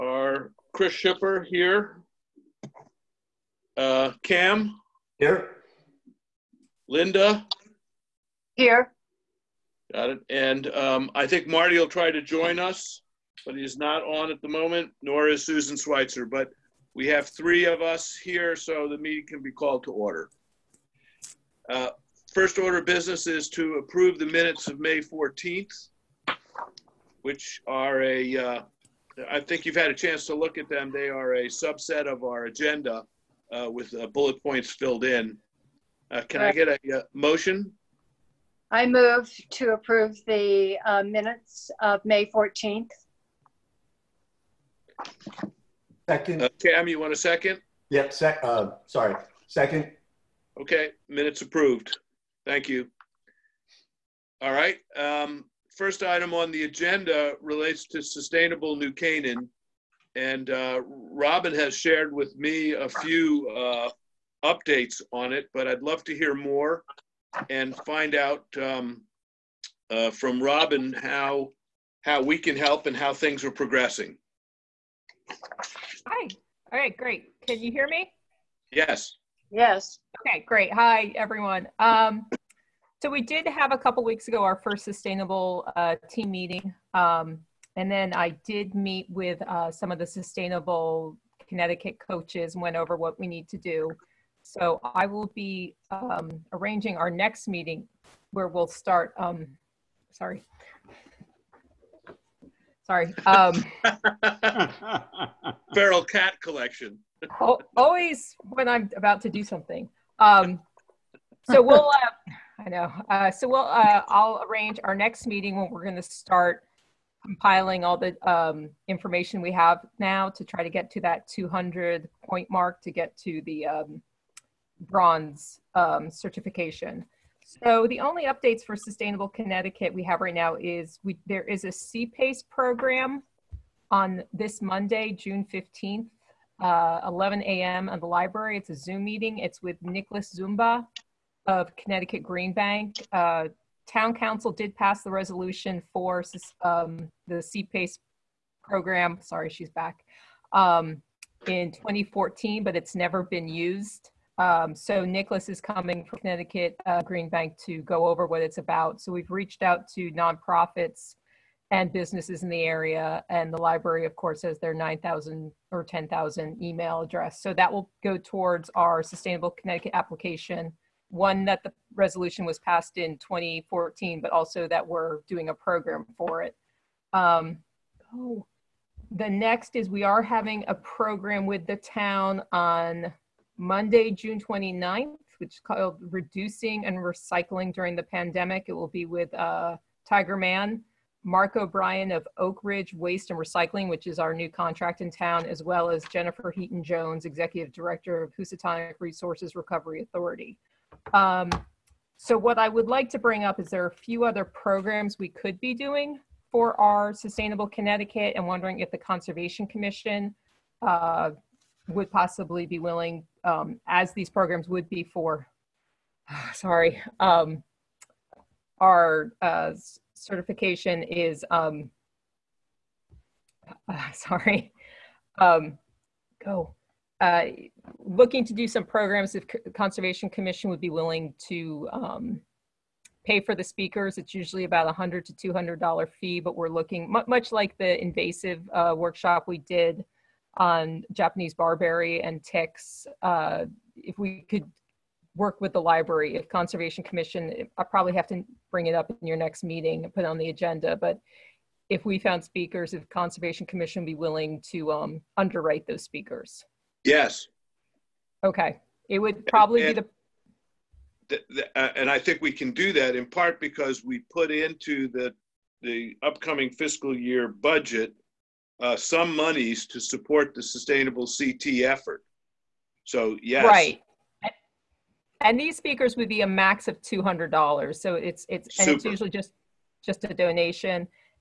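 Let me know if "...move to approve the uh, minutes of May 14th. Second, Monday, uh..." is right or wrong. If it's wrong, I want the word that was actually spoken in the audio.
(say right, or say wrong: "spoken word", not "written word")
wrong: "Okay", not "Monday".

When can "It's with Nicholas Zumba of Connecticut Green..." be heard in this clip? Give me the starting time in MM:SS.
02:19.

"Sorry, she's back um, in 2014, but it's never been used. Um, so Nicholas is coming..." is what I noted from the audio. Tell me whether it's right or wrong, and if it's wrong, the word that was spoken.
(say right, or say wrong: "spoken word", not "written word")
right.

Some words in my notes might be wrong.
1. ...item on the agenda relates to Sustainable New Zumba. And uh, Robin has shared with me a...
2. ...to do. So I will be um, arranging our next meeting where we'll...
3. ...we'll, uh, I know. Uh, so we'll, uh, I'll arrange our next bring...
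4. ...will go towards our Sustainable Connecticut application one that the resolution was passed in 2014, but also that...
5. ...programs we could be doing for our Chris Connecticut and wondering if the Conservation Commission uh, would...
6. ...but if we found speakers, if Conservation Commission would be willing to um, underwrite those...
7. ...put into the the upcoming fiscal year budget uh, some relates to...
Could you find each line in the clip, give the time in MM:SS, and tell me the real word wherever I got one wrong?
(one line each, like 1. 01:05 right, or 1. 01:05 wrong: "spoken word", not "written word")
1. 00:56 wrong: "Canaan", not "Zumba"
2. 01:33 right
3. 01:51 wrong: "meeting", not "bring"
4. 02:47 right
5. 03:24 wrong: "Sustainable", not "Chris"
6. 04:10 right
7. 04:24 wrong: "monies", not "relates".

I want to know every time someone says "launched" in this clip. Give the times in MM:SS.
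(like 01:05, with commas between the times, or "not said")
not said.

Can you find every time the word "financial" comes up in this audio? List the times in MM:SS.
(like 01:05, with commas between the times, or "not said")
not said.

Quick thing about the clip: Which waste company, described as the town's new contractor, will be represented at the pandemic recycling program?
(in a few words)
Oak Ridge Waste and Recycling.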